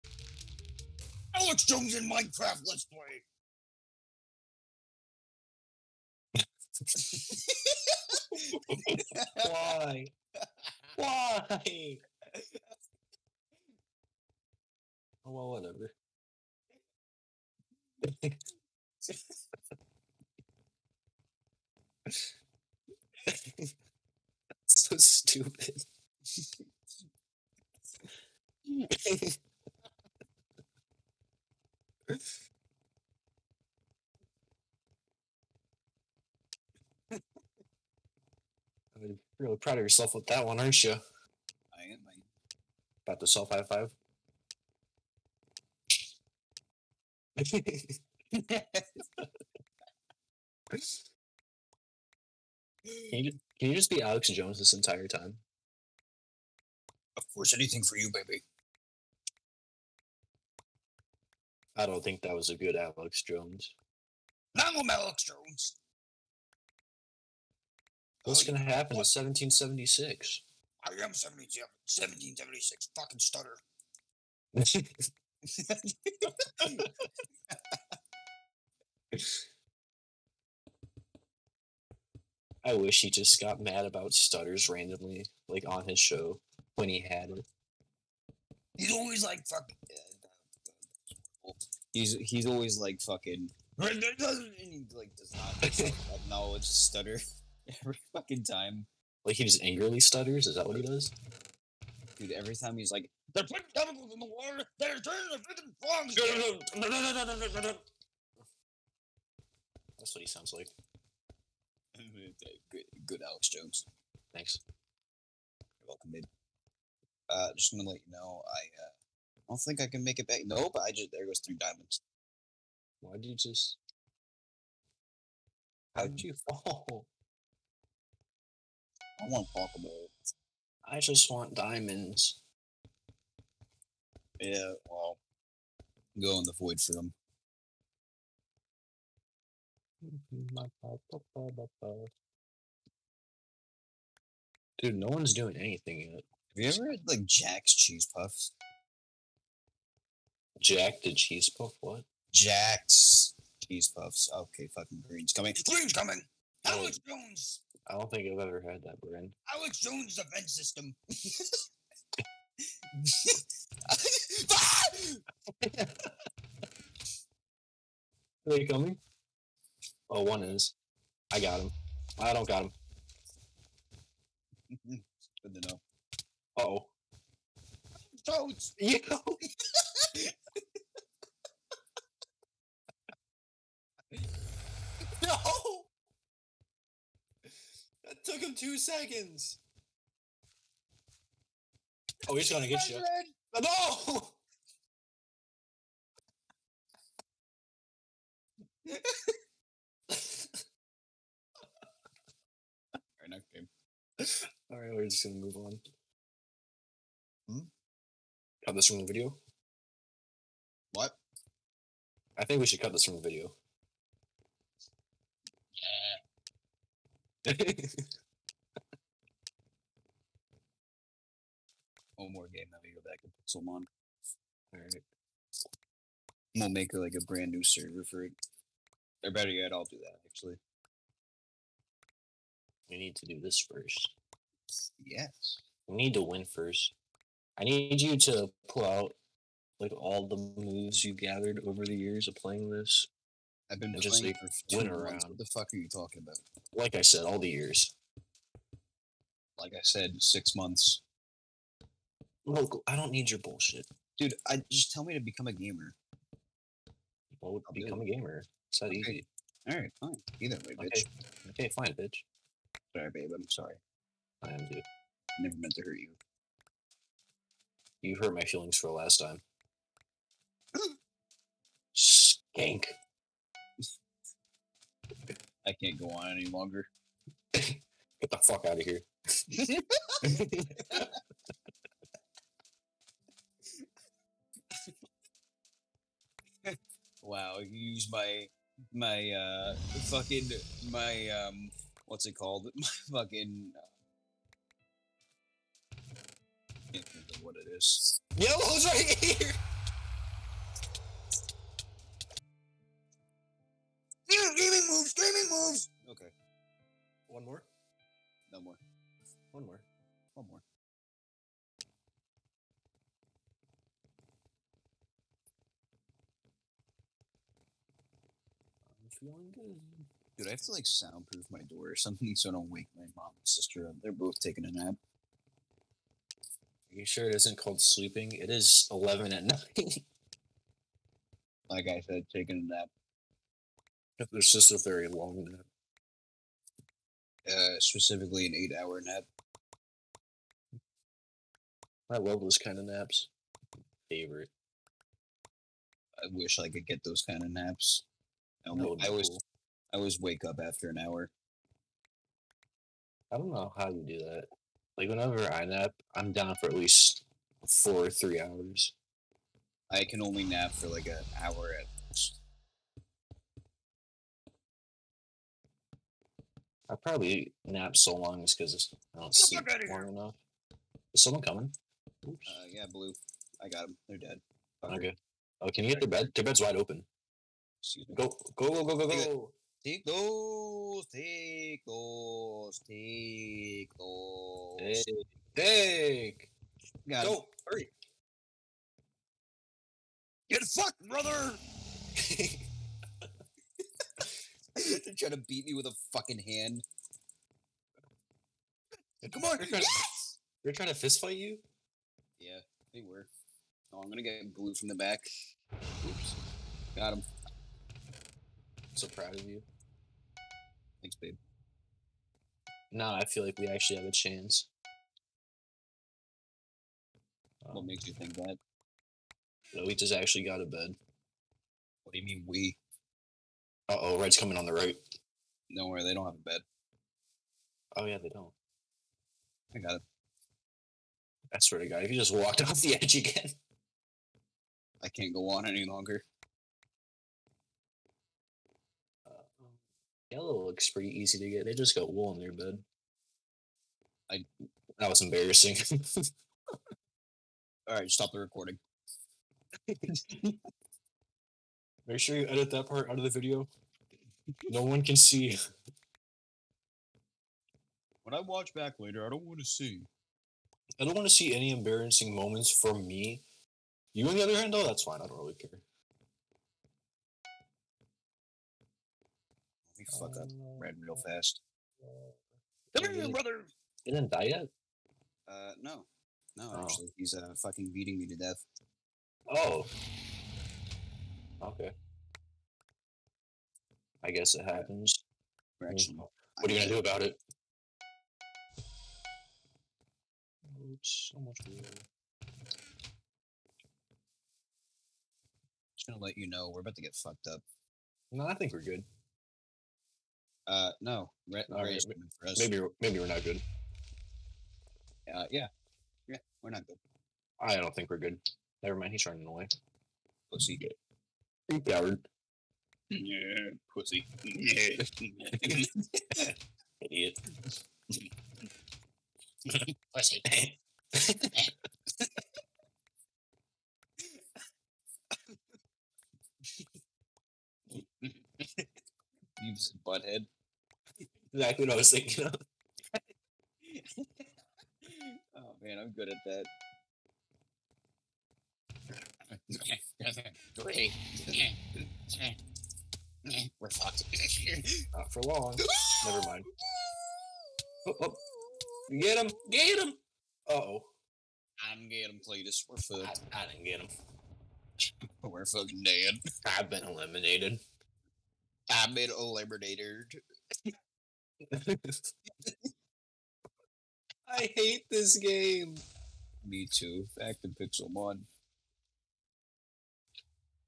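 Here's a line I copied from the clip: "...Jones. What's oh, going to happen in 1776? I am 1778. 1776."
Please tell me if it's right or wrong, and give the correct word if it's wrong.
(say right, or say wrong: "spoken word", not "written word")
wrong: "1776", not "1778".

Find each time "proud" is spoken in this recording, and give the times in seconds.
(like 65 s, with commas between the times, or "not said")
39 s, 409 s.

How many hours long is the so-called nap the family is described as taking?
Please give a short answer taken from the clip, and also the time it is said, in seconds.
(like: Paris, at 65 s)
8 hours, at 338 s.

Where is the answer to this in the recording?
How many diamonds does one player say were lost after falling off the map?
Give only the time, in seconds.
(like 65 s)
121 s.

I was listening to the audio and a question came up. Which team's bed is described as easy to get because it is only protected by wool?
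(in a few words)
Yellow.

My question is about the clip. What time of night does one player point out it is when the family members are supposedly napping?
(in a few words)
11.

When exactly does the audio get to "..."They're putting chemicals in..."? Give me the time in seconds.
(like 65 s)
103 s.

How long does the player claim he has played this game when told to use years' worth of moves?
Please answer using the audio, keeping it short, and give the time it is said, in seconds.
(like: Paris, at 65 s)
6 months, at 250 s.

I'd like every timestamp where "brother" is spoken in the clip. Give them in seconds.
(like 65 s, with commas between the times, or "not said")
391 s, 473 s.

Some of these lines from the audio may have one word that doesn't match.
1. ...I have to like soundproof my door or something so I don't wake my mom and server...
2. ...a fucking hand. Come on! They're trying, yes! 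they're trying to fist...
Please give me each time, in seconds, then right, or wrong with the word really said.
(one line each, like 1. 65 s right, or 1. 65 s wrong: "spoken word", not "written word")
1. 320 s wrong: "sister", not "server"
2. 395 s right.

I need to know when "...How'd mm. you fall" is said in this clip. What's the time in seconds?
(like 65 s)
125 s.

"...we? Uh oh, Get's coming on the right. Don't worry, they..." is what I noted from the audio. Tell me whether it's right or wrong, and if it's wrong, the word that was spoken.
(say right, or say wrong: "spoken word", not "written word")
wrong: "Red", not "Get".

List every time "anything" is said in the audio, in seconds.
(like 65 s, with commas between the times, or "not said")
57 s, 145 s.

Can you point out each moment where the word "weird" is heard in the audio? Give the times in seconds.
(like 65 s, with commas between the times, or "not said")
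491 s.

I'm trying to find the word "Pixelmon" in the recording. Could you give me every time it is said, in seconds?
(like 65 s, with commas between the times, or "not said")
223 s, 567 s.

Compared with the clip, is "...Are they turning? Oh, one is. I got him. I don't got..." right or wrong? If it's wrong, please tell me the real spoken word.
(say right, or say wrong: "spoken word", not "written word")
wrong: "coming", not "turning".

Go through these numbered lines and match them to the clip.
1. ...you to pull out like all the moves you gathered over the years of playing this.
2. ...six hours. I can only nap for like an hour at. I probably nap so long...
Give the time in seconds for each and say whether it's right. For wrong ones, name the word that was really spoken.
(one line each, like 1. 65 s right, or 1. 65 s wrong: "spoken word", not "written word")
1. 238 s right
2. 358 s wrong: "three", not "six".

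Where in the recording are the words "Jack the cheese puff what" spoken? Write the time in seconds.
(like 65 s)
150 s.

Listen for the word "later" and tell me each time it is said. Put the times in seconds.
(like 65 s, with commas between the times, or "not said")
458 s.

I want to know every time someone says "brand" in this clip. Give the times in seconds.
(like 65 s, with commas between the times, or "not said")
159 s, 227 s.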